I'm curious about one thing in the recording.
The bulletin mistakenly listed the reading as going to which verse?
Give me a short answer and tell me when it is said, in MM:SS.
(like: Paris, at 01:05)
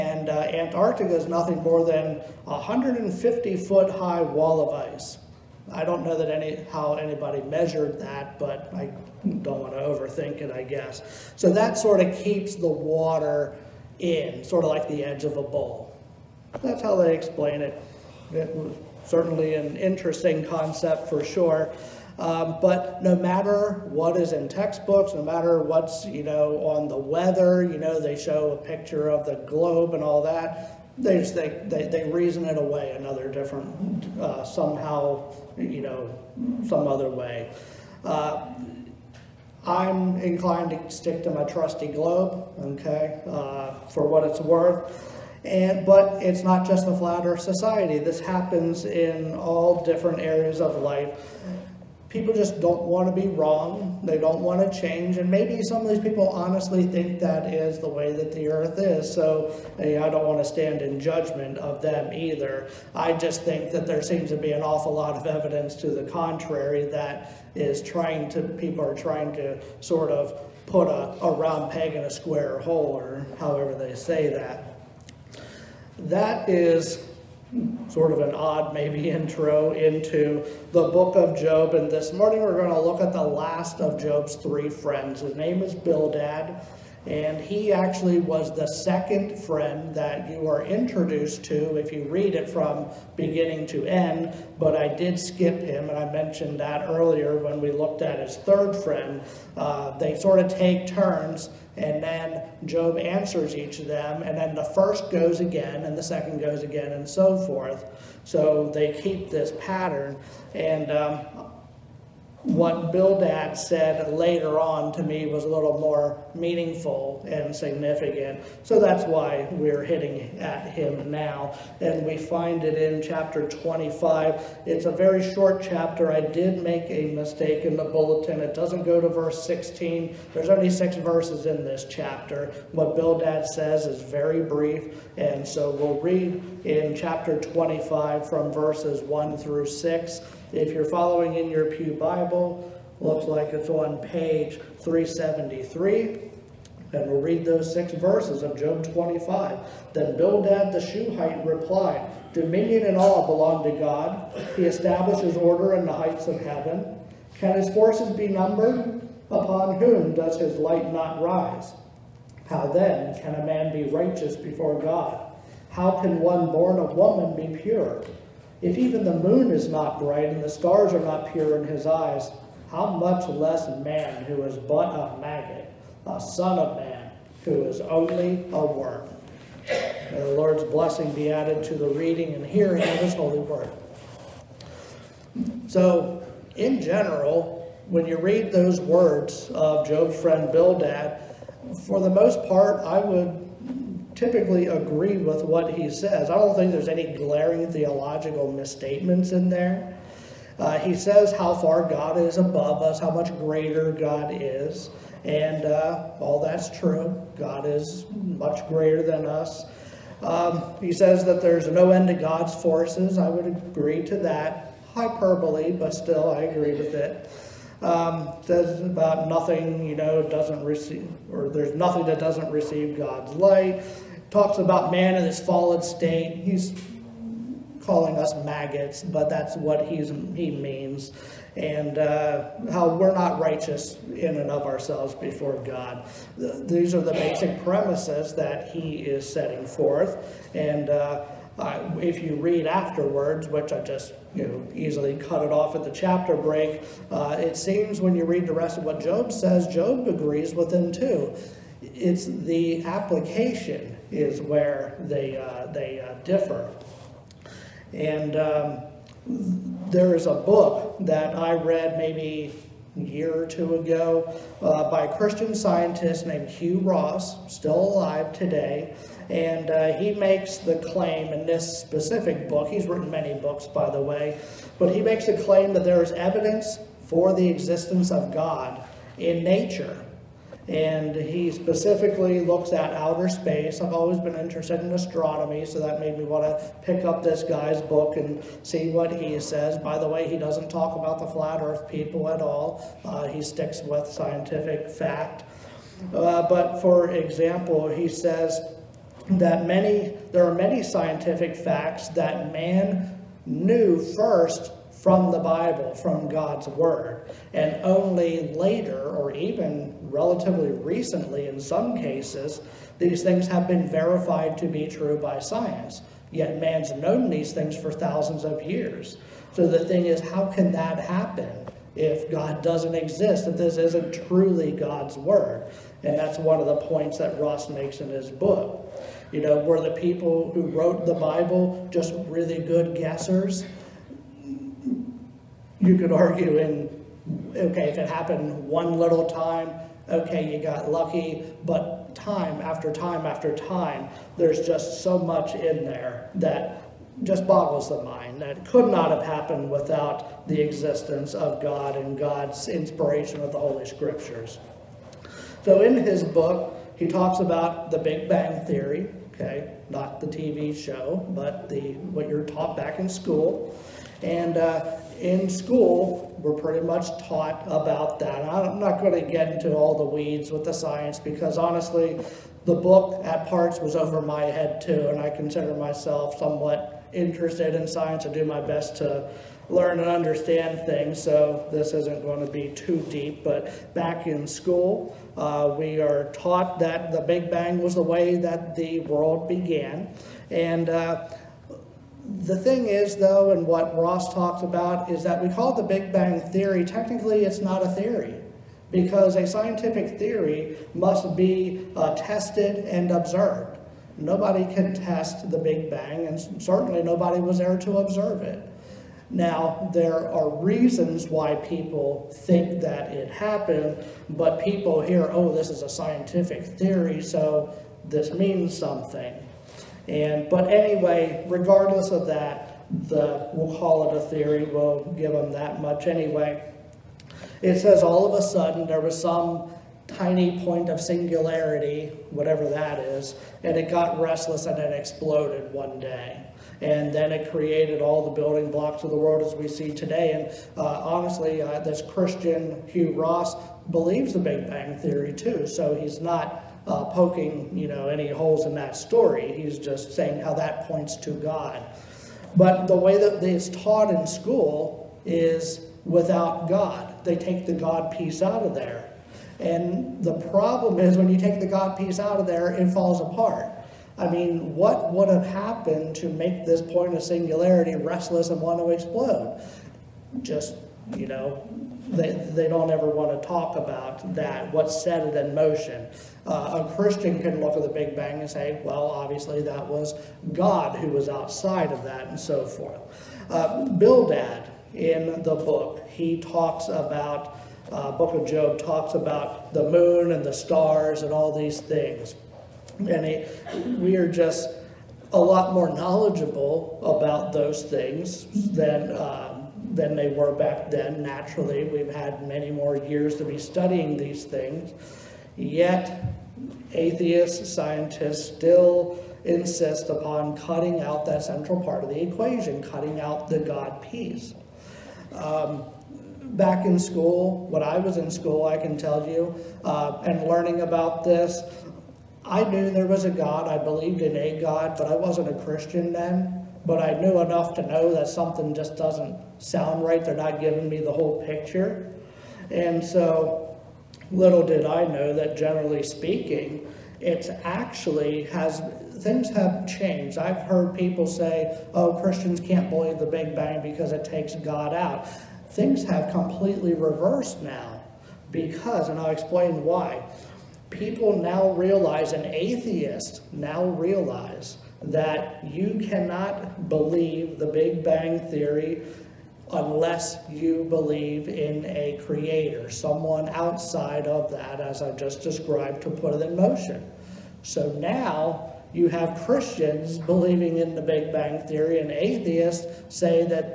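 16, at 02:09.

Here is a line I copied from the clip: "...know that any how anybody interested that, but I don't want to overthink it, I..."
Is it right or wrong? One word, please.
wrong.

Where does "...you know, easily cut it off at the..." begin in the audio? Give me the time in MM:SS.
04:04.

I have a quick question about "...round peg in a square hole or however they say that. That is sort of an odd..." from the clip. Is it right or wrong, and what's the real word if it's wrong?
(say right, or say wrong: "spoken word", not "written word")
right.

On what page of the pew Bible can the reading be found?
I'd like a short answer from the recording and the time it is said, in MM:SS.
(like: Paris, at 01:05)
373, at 02:24.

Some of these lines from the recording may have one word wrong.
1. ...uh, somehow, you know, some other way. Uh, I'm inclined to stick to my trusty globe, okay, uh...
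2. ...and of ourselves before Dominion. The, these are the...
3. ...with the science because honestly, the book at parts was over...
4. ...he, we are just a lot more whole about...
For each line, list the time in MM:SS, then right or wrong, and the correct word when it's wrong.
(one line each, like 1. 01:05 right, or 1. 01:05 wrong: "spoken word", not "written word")
1. 00:34 right
2. 03:54 wrong: "God", not "Dominion"
3. 06:10 right
4. 08:13 wrong: "knowledgeable", not "whole".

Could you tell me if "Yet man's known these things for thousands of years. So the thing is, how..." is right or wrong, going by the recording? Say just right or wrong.
right.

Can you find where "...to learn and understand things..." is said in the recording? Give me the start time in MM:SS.
06:18.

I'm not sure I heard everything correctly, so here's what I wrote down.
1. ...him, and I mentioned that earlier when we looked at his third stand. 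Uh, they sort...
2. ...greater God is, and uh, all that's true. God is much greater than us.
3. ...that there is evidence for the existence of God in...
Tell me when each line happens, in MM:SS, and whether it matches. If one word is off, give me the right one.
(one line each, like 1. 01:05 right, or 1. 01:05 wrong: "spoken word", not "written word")
1. 01:35 wrong: "friend", not "stand"
2. 03:23 right
3. 04:35 right.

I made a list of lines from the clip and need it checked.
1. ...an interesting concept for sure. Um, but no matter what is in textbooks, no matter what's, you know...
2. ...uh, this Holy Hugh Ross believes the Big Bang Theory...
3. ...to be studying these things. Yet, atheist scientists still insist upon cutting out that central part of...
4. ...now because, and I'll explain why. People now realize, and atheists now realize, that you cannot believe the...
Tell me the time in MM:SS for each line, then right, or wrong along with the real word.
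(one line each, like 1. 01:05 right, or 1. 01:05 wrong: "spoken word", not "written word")
1. 00:19 right
2. 07:21 wrong: "Christian", not "Holy"
3. 08:23 right
4. 09:07 right.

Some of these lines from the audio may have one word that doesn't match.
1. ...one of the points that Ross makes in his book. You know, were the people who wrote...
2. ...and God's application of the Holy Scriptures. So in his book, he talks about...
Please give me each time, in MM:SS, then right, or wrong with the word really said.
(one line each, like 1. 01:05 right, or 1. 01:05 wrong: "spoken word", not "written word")
1. 05:26 right
2. 05:51 wrong: "inspiration", not "application".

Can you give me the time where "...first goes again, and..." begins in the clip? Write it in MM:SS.
01:44.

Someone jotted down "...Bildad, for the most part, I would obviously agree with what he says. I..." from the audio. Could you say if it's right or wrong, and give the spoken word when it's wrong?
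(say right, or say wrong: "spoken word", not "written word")
wrong: "typically", not "obviously".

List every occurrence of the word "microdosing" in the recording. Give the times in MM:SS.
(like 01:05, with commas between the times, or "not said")
not said.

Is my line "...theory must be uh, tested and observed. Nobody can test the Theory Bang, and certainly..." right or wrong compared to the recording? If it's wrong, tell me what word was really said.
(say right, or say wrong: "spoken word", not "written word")
wrong: "Big", not "Theory".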